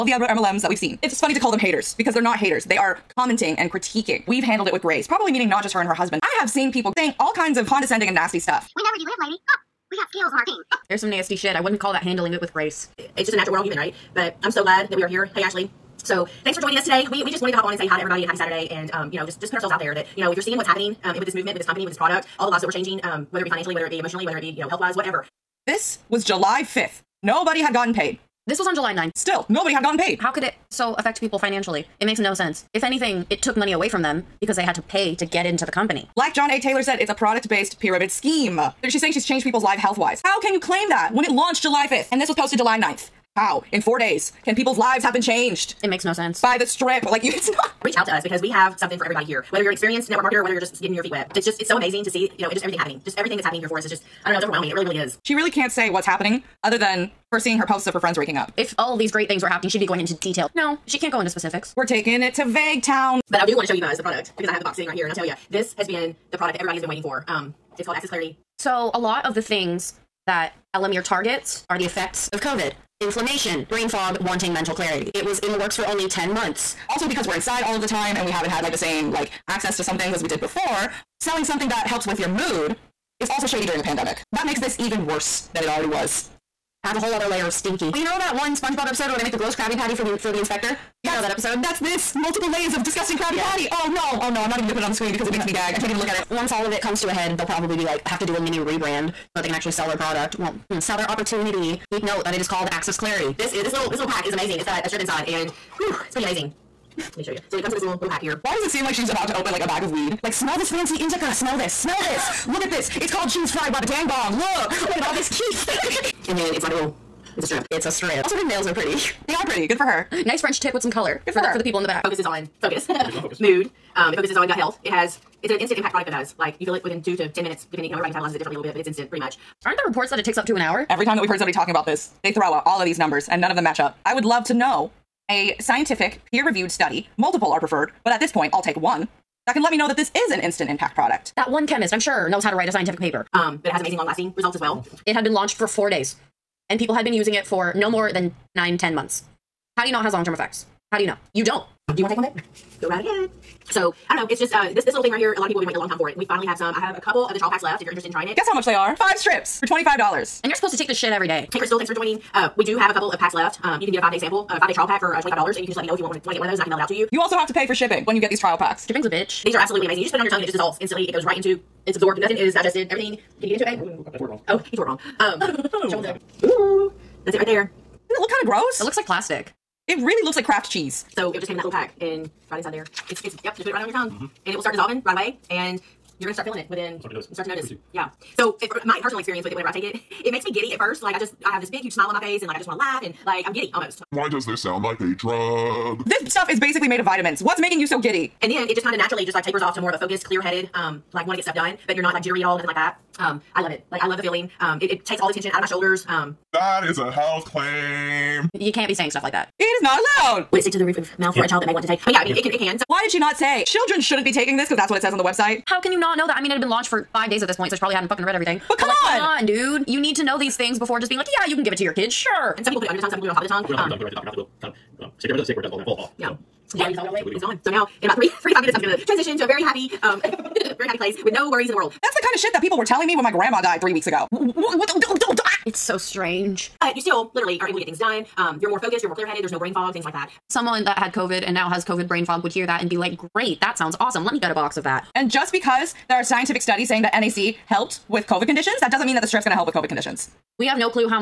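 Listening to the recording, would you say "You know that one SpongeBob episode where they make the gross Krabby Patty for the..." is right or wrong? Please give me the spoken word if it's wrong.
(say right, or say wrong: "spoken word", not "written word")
right.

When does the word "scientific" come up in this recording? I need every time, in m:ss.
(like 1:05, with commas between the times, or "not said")
2:15, 2:22, 4:06.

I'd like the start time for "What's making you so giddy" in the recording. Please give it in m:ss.
3:17.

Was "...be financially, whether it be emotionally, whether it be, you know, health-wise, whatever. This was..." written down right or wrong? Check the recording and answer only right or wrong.
right.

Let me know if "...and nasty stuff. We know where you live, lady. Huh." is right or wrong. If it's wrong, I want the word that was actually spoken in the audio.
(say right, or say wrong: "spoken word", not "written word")
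right.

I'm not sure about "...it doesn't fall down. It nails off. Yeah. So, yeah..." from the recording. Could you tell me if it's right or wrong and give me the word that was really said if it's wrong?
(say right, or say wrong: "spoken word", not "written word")
wrong: "falls", not "nails".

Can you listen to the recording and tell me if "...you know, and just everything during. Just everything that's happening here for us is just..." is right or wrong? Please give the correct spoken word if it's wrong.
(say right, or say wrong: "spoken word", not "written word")
wrong: "happening", not "during".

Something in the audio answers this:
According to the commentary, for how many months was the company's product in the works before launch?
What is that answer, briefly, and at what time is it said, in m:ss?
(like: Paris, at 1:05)
10 months, at 1:16.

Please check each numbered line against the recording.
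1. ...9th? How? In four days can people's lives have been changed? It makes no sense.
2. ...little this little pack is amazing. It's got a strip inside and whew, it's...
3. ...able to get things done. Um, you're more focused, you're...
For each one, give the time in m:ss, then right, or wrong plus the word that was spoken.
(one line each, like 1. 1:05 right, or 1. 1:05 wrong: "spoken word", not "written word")
1. 0:42 right
2. 1:43 right
3. 3:57 right.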